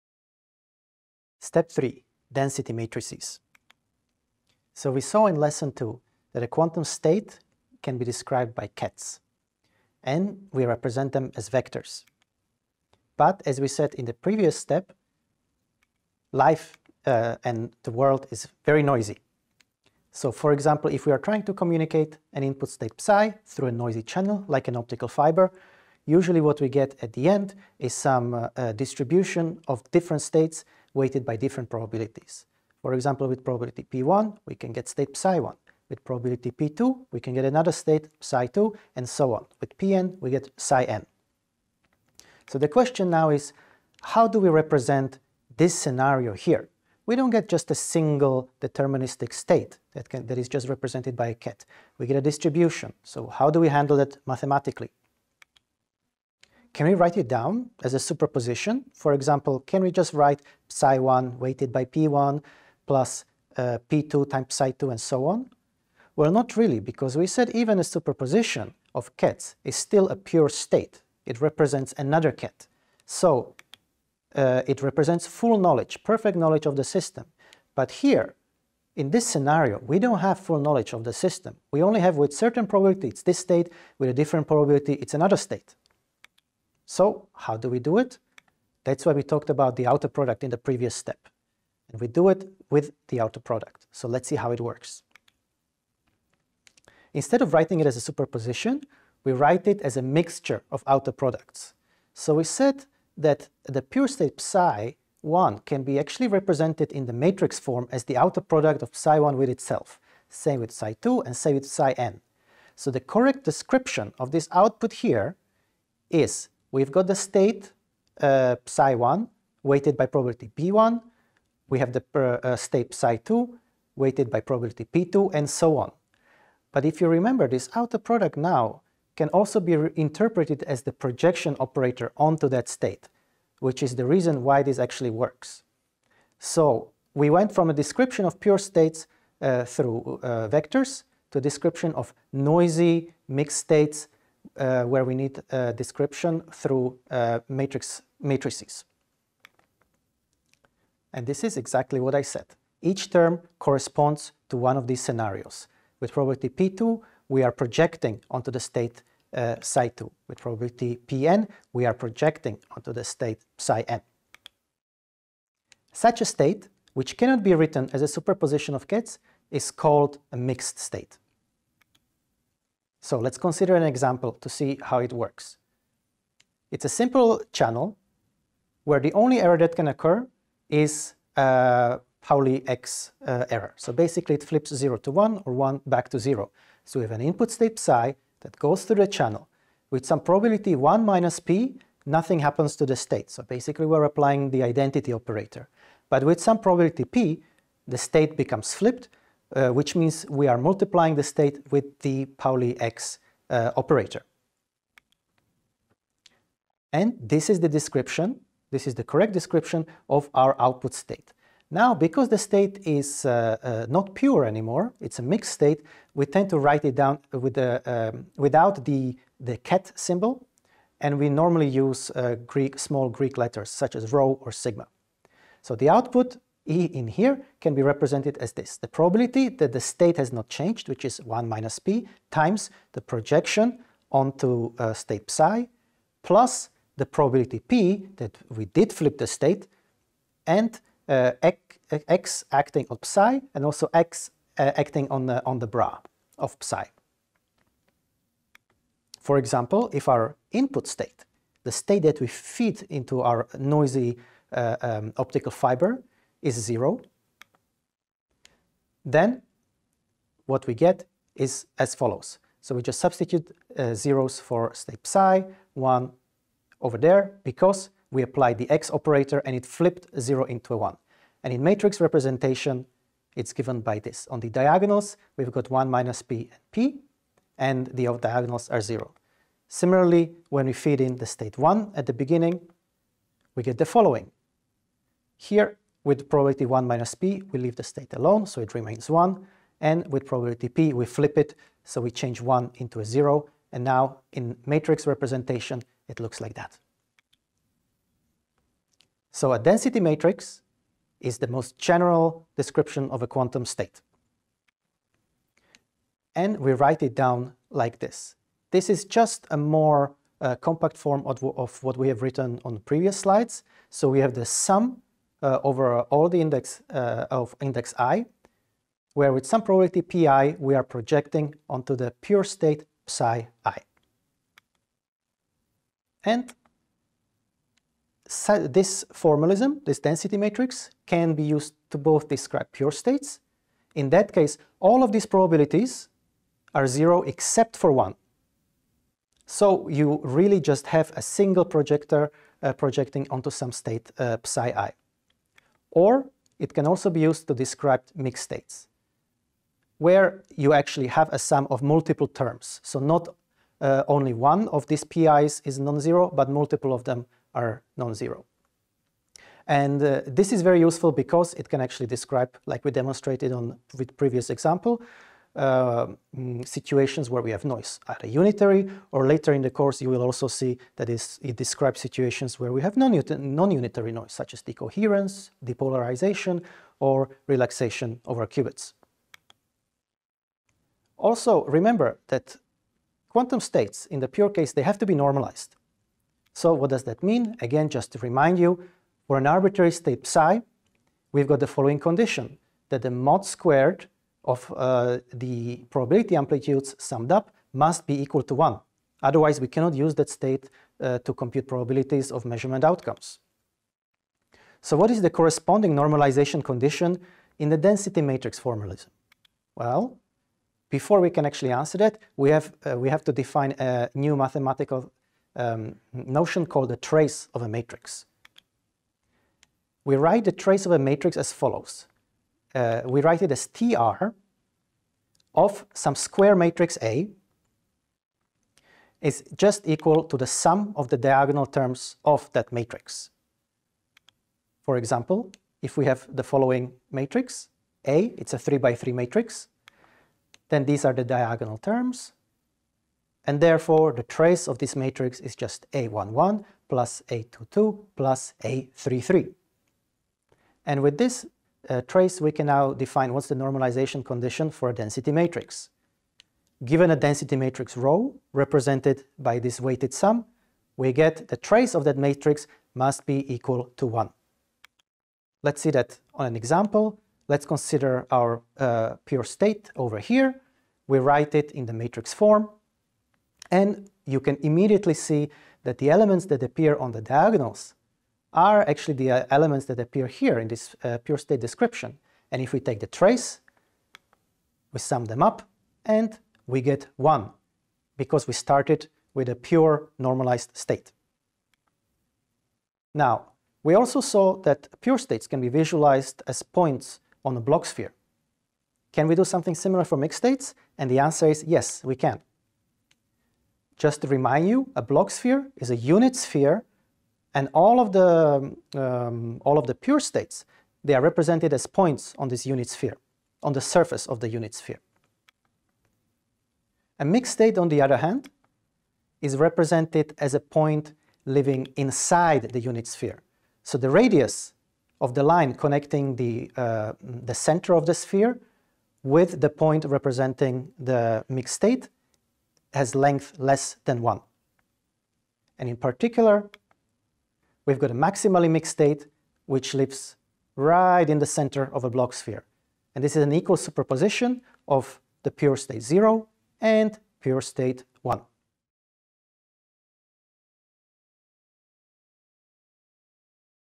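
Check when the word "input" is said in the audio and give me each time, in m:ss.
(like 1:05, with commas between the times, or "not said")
0:22, 3:07, 4:10.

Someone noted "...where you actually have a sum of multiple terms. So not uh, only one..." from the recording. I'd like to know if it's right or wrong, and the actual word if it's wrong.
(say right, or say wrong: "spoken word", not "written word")
right.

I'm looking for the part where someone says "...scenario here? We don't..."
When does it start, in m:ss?
0:45.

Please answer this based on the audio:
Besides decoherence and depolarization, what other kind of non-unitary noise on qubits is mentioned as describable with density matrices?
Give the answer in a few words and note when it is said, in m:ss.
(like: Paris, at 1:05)
Relaxation, at 6:17.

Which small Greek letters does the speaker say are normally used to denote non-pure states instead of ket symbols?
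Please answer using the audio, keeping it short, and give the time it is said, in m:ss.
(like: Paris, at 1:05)
Rho or sigma, at 3:44.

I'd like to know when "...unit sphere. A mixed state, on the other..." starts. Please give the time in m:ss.
8:34.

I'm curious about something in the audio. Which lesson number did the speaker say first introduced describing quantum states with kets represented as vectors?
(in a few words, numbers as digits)
Lesson two.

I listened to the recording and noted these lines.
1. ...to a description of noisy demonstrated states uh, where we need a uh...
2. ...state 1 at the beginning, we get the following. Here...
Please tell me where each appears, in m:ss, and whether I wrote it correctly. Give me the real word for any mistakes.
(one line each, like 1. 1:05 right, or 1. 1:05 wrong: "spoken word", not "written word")
1. 2:21 wrong: "mixed", not "demonstrated"
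2. 4:41 right.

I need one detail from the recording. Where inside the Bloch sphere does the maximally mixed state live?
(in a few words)
Right in the center.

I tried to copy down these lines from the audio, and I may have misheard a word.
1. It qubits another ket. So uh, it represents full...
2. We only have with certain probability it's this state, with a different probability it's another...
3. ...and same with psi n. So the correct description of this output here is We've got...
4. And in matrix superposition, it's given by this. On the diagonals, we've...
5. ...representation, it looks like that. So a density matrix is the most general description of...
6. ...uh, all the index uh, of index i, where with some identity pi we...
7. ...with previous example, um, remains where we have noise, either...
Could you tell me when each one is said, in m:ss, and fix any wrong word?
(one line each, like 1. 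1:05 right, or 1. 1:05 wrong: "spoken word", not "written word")
1. 1:11 wrong: "represents", not "qubits"
2. 1:21 right
3. 1:51 right
4. 4:31 wrong: "representation", not "superposition"
5. 4:55 right
6. 5:15 wrong: "probability", not "identity"
7. 6:03 wrong: "situations", not "remains".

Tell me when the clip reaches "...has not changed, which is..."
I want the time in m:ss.
3:50.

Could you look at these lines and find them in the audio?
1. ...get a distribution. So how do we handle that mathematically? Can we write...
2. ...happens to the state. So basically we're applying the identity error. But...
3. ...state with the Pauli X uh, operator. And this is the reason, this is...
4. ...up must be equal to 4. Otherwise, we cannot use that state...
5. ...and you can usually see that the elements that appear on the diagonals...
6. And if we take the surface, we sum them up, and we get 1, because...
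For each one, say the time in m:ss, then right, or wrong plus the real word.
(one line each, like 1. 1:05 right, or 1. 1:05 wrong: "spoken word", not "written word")
1. 0:52 right
2. 3:12 wrong: "operator", not "error"
3. 3:21 wrong: "description", not "reason"
4. 6:37 wrong: "1", not "4"
5. 7:53 wrong: "immediately", not "usually"
6. 8:02 wrong: "trace", not "surface".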